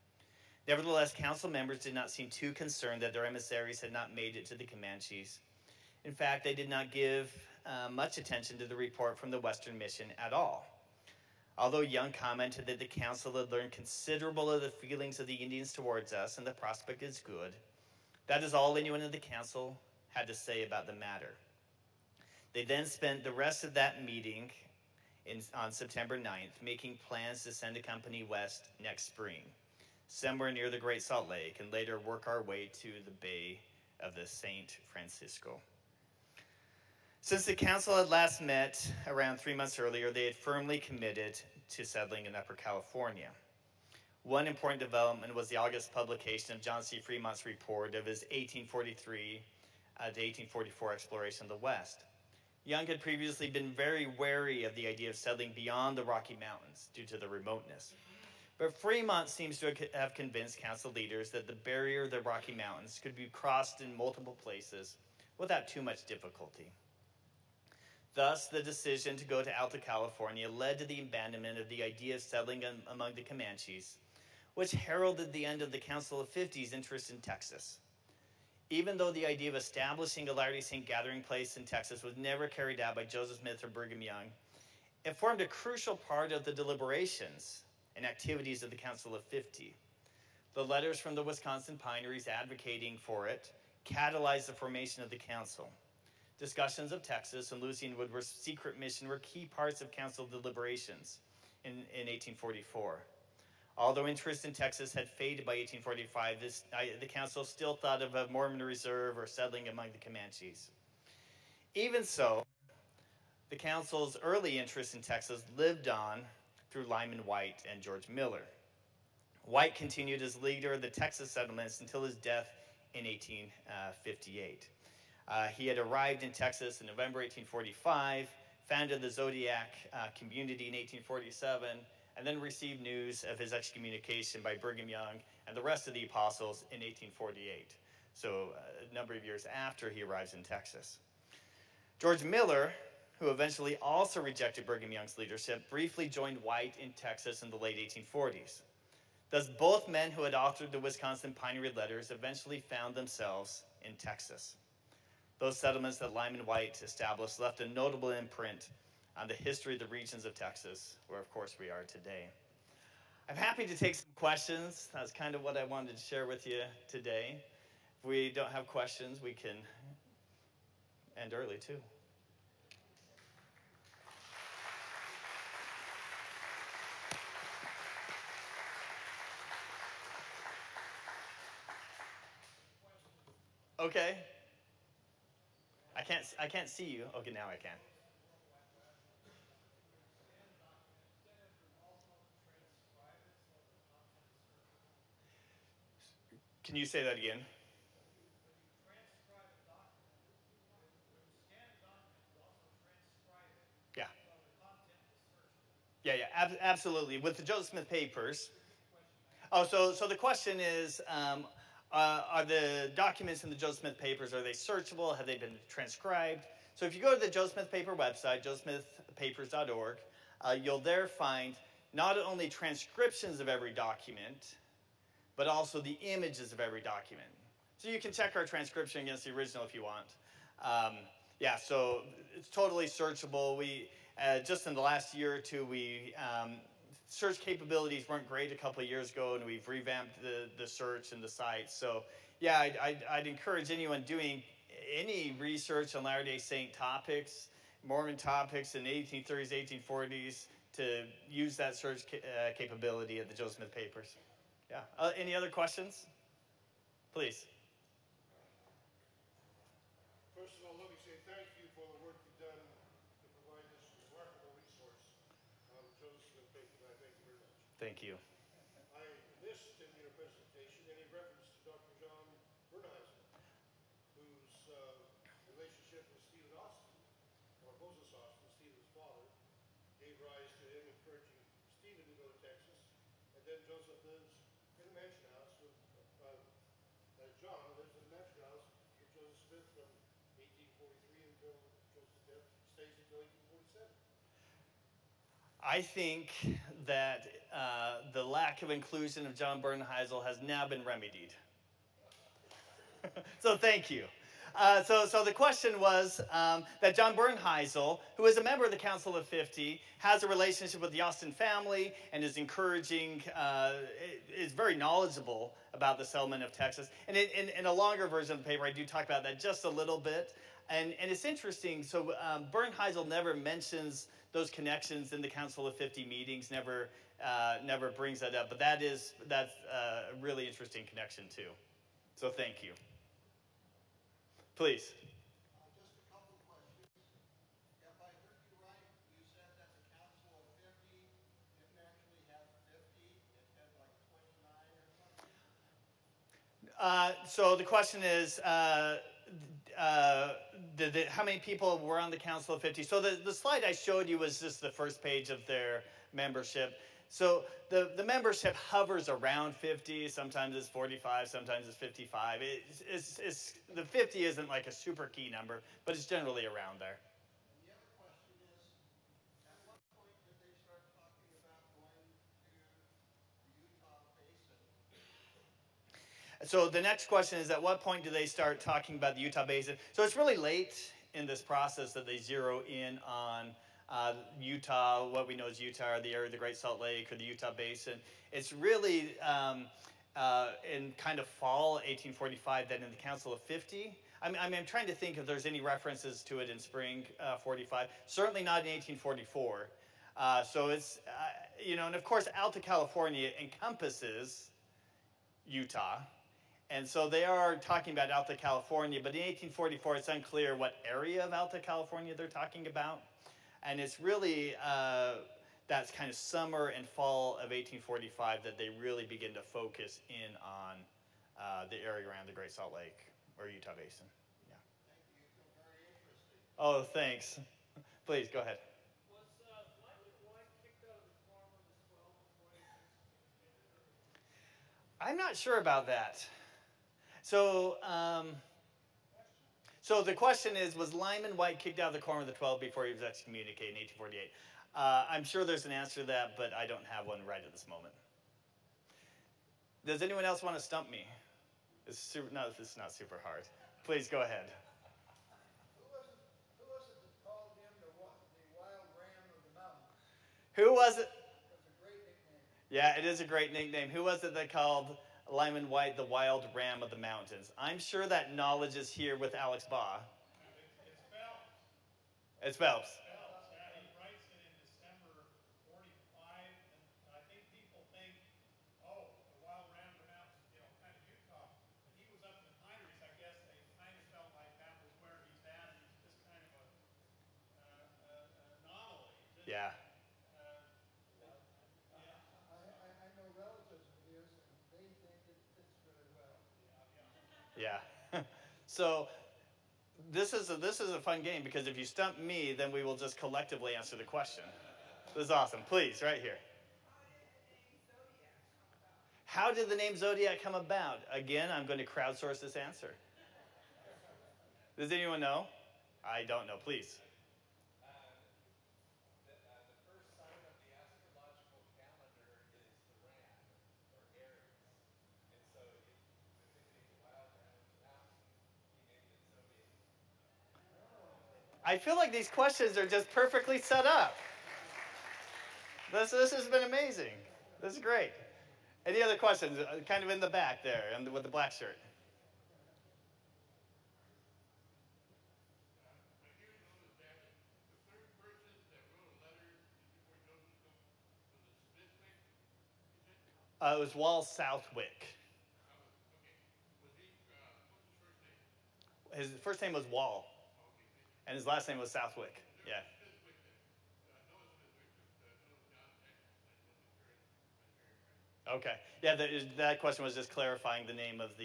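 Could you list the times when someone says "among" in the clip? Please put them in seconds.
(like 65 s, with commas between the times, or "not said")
72 s, 109 s.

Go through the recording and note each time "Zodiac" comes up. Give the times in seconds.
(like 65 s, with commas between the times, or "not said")
129 s, 509 s.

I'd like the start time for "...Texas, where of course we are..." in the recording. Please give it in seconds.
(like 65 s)
160 s.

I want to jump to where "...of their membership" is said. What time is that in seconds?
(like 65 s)
355 s.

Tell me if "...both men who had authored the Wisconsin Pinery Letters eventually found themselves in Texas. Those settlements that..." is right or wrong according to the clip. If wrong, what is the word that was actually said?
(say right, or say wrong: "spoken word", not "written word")
right.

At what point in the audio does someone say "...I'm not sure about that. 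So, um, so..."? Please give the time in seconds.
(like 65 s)
435 s.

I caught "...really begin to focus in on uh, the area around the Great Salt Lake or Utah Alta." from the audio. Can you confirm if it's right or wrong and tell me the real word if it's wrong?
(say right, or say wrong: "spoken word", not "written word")
wrong: "Basin", not "Alta".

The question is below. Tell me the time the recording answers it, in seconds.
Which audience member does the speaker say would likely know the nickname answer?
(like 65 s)
469 s.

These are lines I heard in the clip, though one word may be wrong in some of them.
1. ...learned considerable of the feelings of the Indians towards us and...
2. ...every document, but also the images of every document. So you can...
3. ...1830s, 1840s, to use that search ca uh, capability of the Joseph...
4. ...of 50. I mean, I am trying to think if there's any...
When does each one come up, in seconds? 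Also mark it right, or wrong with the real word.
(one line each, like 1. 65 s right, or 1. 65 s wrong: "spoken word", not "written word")
1. 13 s right
2. 223 s right
3. 248 s right
4. 393 s right.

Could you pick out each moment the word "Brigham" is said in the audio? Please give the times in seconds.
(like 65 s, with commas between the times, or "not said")
83 s, 134 s, 144 s.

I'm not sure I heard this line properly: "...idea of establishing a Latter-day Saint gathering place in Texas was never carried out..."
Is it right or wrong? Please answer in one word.
right.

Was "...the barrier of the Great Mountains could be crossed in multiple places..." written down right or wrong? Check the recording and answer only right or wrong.
wrong.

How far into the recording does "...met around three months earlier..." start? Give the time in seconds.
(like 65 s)
38 s.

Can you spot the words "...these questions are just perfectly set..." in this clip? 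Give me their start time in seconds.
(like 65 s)
532 s.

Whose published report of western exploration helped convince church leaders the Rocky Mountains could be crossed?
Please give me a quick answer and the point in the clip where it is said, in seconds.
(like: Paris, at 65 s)
John C. Fremont, at 46 s.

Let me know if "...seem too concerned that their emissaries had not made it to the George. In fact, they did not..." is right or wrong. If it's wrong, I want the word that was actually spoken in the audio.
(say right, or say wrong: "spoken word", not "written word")
wrong: "Comanches", not "George".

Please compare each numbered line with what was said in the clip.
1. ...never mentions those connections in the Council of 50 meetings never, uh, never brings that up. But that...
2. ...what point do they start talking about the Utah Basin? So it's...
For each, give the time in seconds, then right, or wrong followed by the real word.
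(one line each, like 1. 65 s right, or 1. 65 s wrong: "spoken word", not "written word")
1. 323 s right
2. 377 s right.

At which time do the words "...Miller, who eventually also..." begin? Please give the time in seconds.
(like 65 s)
142 s.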